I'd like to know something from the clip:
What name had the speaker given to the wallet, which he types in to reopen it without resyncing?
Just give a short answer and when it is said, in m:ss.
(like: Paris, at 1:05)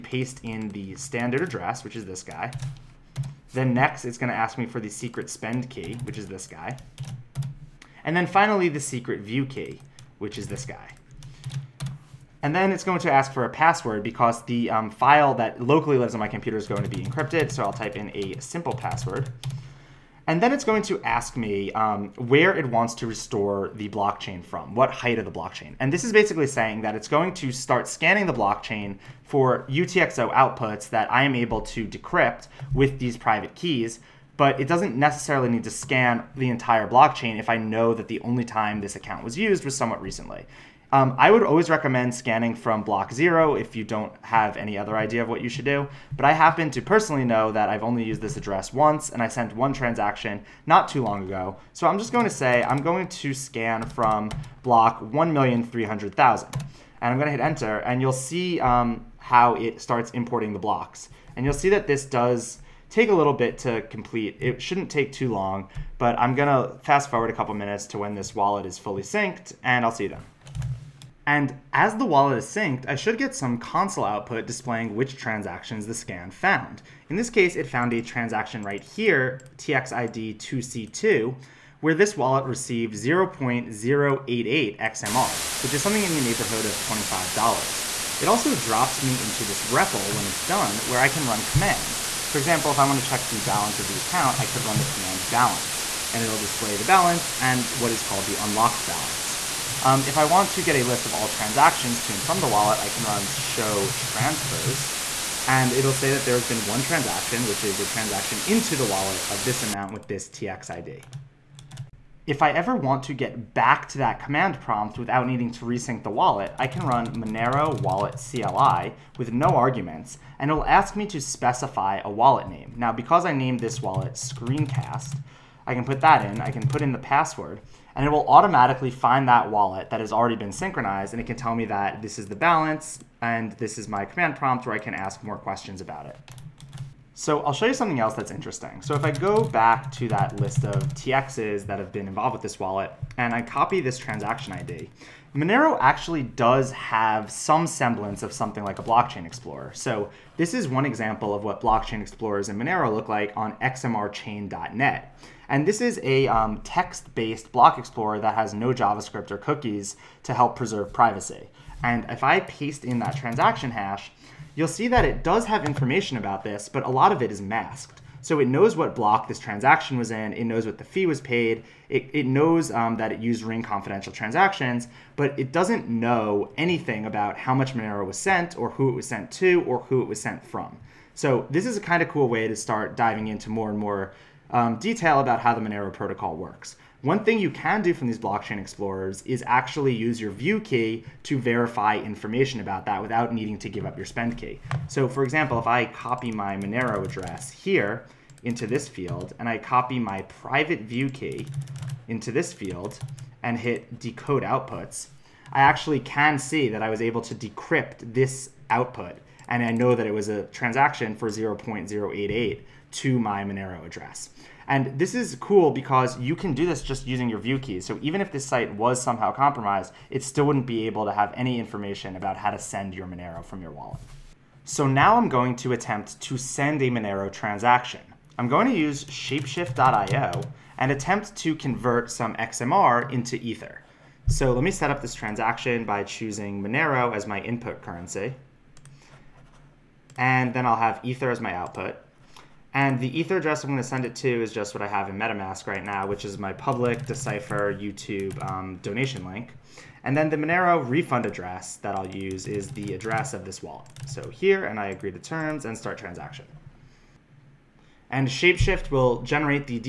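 Screencast, at 2:04.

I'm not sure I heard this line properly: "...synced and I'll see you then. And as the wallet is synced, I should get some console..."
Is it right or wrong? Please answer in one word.
right.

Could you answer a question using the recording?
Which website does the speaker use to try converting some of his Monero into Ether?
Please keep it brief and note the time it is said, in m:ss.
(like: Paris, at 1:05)
shapeshift.io, at 3:49.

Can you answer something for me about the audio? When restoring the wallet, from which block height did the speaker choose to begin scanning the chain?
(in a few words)
1,300,000.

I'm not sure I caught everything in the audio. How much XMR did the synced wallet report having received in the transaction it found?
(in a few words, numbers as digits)
0.088 XMR.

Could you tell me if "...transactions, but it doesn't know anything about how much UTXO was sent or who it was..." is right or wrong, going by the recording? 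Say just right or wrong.
wrong.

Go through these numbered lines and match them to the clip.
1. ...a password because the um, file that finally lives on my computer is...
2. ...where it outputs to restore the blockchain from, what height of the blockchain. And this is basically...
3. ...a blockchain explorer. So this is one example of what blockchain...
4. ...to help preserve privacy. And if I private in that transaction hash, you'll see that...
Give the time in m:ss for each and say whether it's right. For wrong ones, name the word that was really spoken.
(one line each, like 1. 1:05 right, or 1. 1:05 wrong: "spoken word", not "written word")
1. 0:13 wrong: "locally", not "finally"
2. 0:22 wrong: "wants", not "outputs"
3. 2:28 right
4. 2:40 wrong: "paste", not "private".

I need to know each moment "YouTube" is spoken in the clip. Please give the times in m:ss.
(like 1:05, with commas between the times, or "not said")
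4:07.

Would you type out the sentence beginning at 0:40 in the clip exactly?
Um, I would always recommend scanning from block zero if you don't have any other idea of what you should do.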